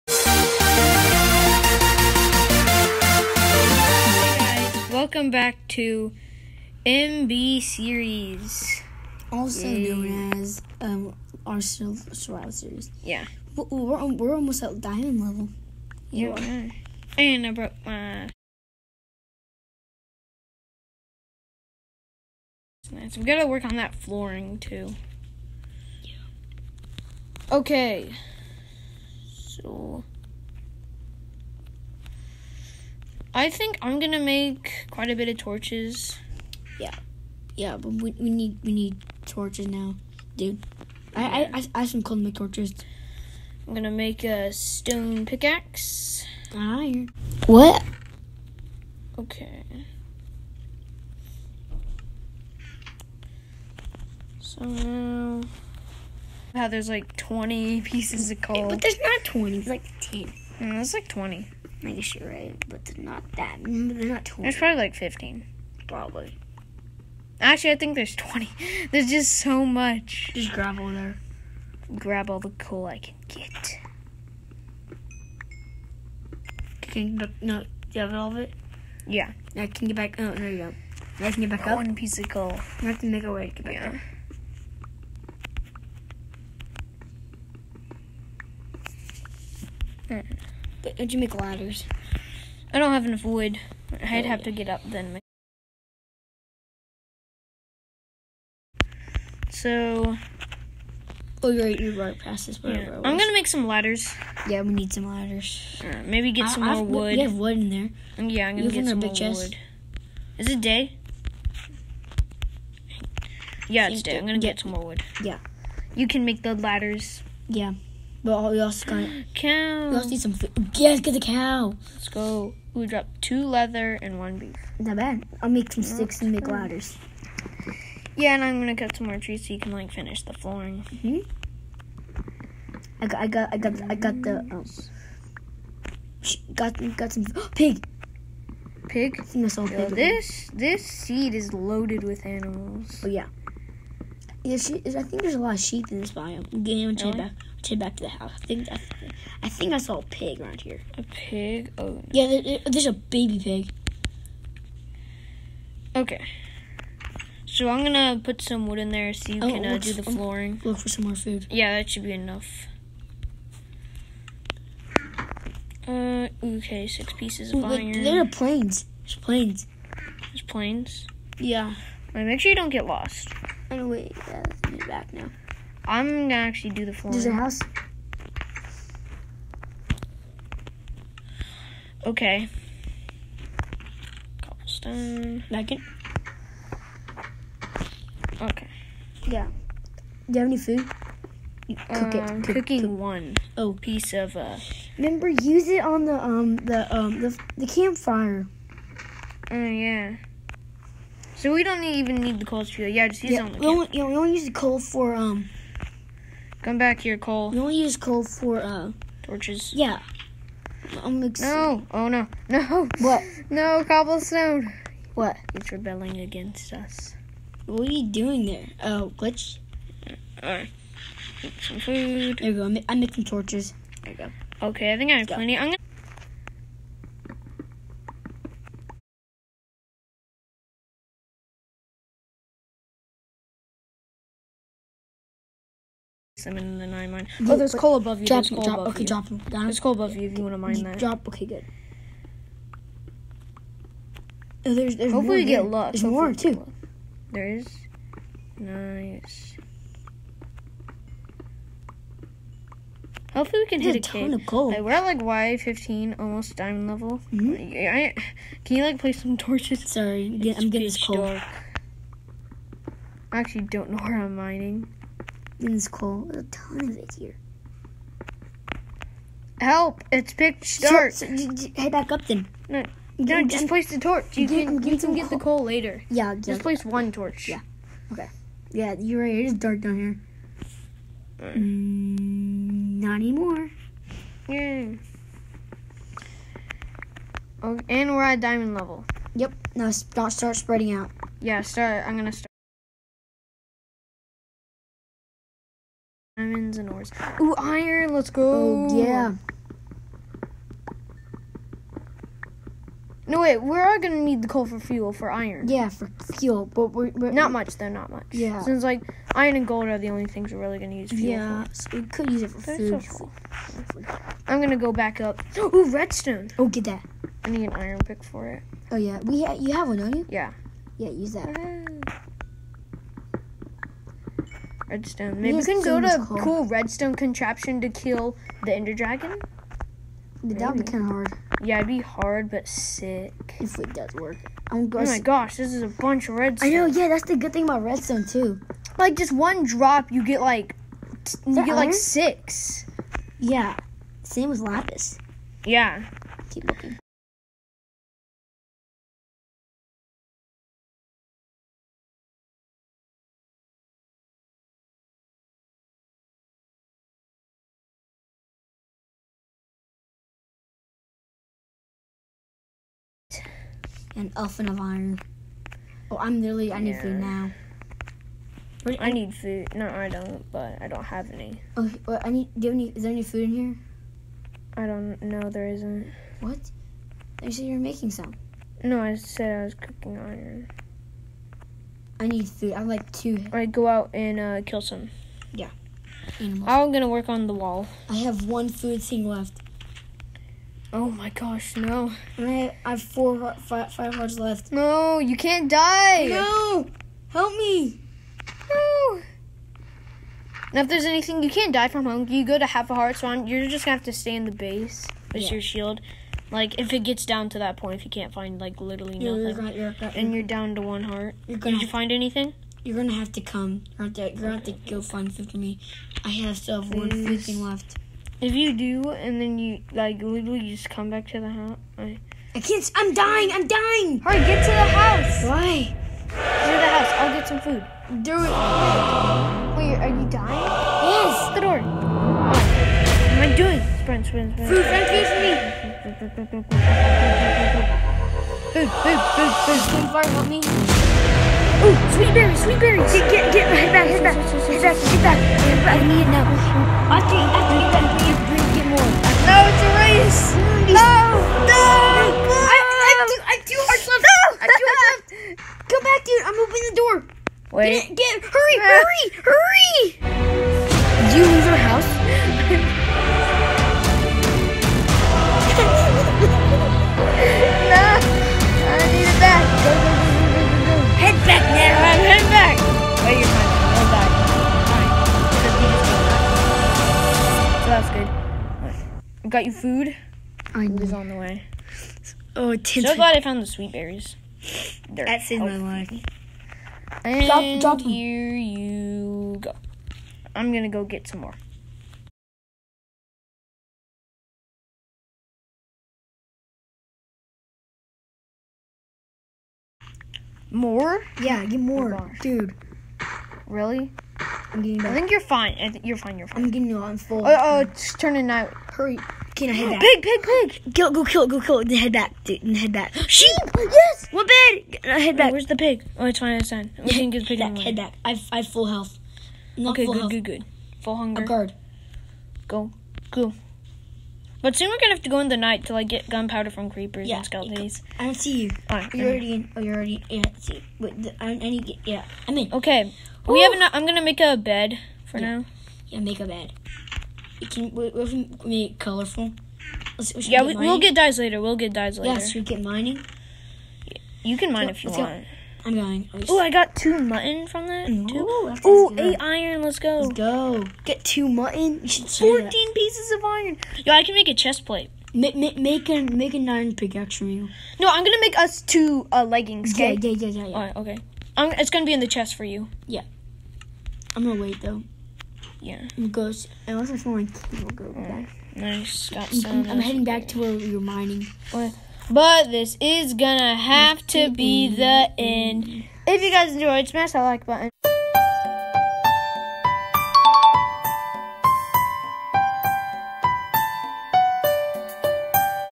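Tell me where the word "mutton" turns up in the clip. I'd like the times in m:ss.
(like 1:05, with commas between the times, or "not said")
9:07, 9:11.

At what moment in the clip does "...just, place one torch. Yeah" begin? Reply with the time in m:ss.
4:36.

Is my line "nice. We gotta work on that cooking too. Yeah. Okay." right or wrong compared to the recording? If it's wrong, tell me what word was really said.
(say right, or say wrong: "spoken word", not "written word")
wrong: "flooring", not "cooking".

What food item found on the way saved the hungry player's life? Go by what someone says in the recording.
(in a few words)
Sweet berries.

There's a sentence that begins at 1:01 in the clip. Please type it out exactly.
I guess you're right, but they're not that.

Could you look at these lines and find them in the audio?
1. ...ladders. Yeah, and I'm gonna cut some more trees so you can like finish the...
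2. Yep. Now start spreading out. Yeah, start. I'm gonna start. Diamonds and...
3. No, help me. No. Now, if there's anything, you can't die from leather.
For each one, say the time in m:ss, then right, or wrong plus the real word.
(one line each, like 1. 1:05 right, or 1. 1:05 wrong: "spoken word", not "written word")
1. 2:06 right
2. 4:49 right
3. 6:36 wrong: "hunger", not "leather".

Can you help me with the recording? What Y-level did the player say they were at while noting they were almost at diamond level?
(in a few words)
15.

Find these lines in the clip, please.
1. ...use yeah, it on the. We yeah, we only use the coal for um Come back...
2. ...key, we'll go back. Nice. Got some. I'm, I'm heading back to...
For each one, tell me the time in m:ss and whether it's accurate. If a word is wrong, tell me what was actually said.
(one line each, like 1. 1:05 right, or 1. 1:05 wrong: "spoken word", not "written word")
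1. 3:23 right
2. 9:27 right.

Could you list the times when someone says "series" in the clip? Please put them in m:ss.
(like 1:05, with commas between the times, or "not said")
0:07, 0:12.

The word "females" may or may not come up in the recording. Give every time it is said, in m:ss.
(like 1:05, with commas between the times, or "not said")
not said.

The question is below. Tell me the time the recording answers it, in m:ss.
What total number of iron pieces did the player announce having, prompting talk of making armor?
9:12.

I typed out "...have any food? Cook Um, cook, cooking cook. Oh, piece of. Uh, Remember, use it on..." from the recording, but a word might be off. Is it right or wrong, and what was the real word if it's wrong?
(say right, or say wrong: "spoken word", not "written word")
right.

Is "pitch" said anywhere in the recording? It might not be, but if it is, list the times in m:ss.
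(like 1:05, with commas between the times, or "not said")
4:30.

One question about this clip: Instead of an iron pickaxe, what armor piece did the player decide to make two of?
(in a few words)
Leggings.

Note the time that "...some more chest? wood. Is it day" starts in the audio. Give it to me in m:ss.
1:48.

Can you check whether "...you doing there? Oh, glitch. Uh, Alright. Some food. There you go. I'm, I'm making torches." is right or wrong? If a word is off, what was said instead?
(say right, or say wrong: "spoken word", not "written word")
right.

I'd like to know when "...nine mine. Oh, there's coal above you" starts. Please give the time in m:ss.
3:56.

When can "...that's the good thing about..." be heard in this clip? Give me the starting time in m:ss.
5:37.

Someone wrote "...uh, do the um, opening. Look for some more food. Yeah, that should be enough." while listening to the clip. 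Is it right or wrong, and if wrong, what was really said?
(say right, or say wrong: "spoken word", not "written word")
wrong: "flooring", not "opening".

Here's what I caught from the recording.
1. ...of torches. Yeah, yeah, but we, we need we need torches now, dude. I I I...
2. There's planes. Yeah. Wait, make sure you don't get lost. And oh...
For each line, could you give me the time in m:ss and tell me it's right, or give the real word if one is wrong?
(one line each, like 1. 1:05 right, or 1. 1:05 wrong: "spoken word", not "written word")
1. 0:35 right
2. 2:50 right.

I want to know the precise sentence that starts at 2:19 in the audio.
this this seed is loaded with animals.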